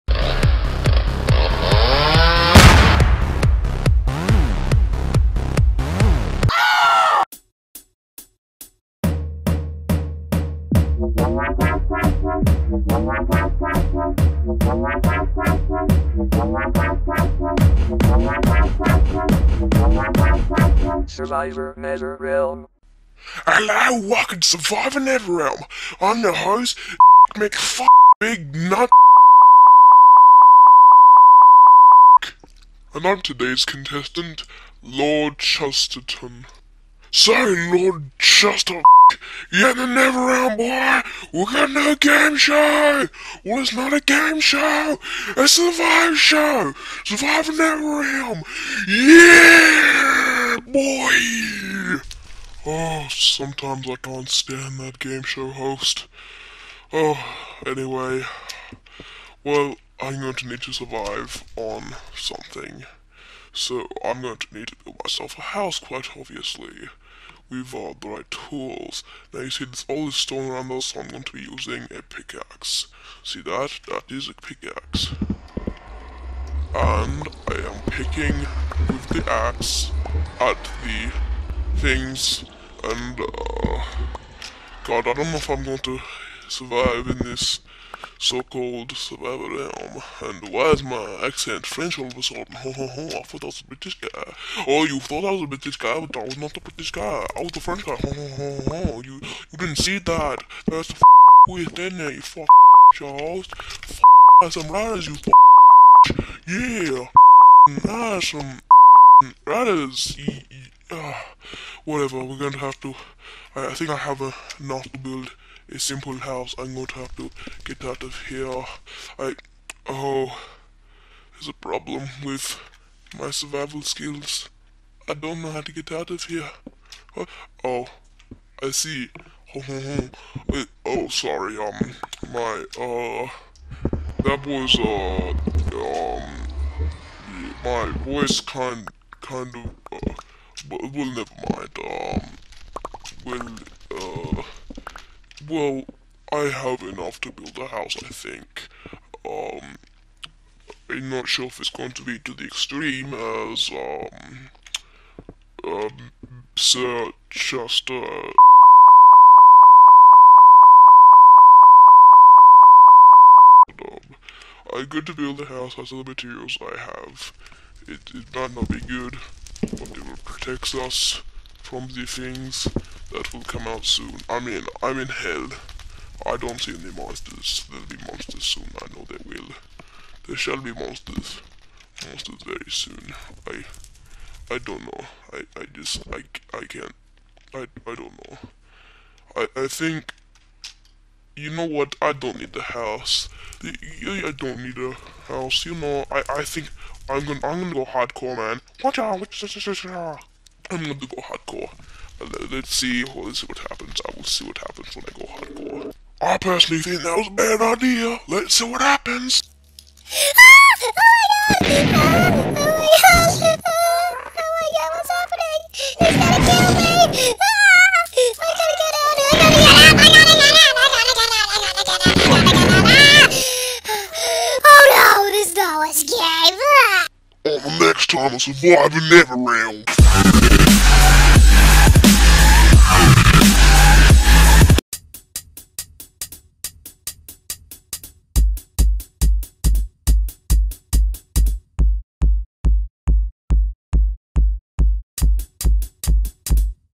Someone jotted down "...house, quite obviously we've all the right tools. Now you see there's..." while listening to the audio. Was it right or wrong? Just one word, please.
right.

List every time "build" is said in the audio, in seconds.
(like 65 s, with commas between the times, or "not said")
64 s, 114 s, 147 s, 165 s.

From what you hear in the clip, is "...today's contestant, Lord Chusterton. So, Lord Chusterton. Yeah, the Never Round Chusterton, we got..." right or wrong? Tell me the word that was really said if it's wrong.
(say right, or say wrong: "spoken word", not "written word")
wrong: "Boy", not "Chusterton".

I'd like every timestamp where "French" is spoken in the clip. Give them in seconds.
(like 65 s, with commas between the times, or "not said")
91 s, 97 s.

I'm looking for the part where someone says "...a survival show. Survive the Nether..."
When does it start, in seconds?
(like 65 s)
45 s.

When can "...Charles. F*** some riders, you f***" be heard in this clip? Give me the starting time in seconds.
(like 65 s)
102 s.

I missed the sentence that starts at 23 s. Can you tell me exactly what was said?
Hello, welcome to Survivor Nether Realm.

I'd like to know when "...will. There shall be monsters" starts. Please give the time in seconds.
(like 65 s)
179 s.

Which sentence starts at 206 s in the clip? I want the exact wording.
I personally think that was a bad idea.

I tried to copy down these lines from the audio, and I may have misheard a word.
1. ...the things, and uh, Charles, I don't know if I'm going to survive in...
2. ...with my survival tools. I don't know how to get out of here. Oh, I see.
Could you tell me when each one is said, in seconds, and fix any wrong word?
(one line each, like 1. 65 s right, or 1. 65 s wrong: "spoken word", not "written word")
1. 80 s wrong: "God", not "Charles"
2. 122 s wrong: "skills", not "tools".